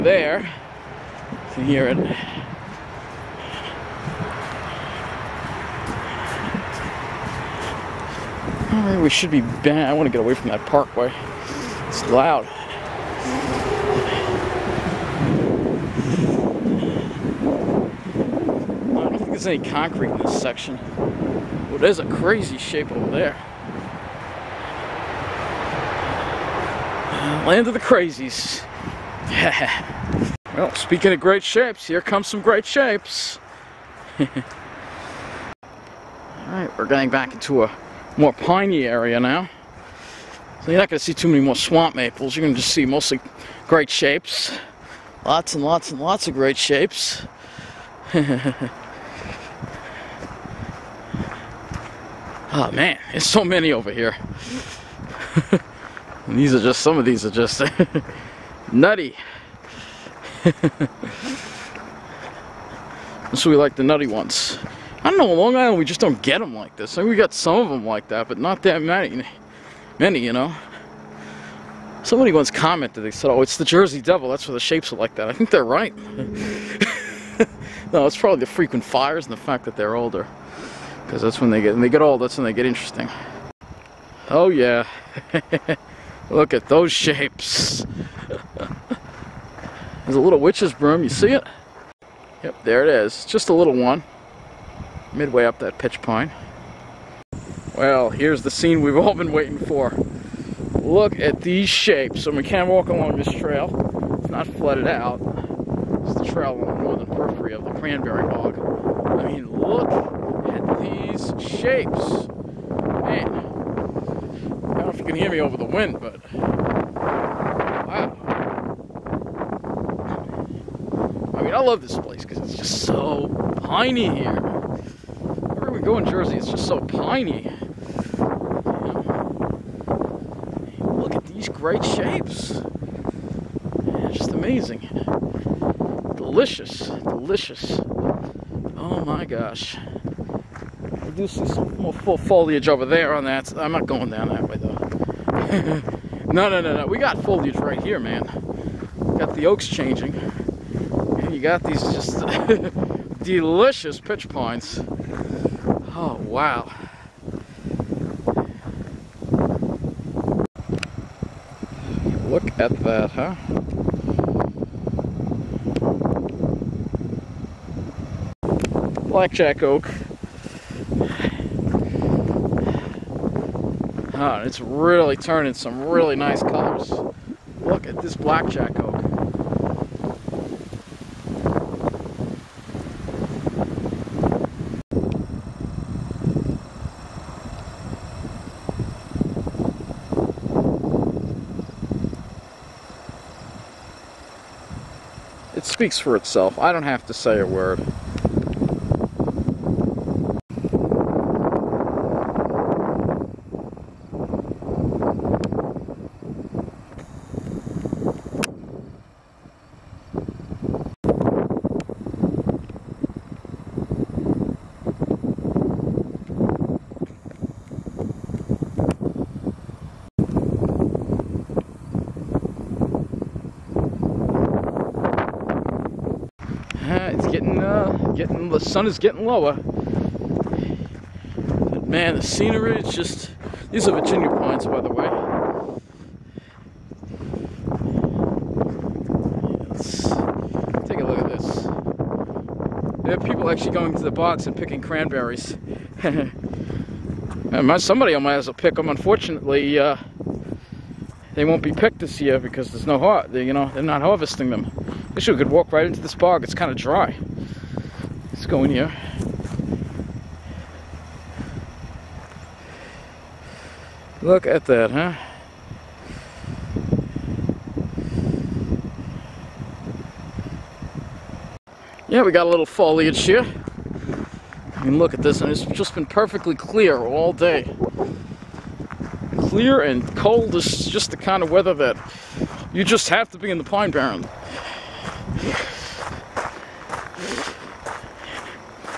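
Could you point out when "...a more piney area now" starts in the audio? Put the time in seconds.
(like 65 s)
37 s.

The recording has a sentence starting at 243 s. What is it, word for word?
There are people actually going to the box and picking cranberries.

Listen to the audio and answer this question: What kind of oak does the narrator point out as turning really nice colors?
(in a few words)
Blackjack oak.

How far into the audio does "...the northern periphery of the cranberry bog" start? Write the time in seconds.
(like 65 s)
106 s.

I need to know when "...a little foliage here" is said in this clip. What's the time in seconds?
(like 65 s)
272 s.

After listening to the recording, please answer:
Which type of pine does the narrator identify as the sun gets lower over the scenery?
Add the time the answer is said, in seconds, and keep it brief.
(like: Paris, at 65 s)
Virginia pines, at 234 s.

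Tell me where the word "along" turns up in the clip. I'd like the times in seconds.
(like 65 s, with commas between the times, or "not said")
102 s.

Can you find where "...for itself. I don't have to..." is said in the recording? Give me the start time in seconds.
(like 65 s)
195 s.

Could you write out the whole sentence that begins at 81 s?
Because that's when they get, and they get old, that's when they get interesting.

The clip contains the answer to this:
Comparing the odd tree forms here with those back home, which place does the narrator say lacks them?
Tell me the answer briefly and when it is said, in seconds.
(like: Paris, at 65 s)
Long Island, at 65 s.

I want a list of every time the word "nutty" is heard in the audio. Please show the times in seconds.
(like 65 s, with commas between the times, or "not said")
58 s, 63 s.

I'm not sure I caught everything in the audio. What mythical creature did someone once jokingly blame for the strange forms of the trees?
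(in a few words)
the Jersey Devil.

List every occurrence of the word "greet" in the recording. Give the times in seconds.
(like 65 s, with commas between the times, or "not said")
not said.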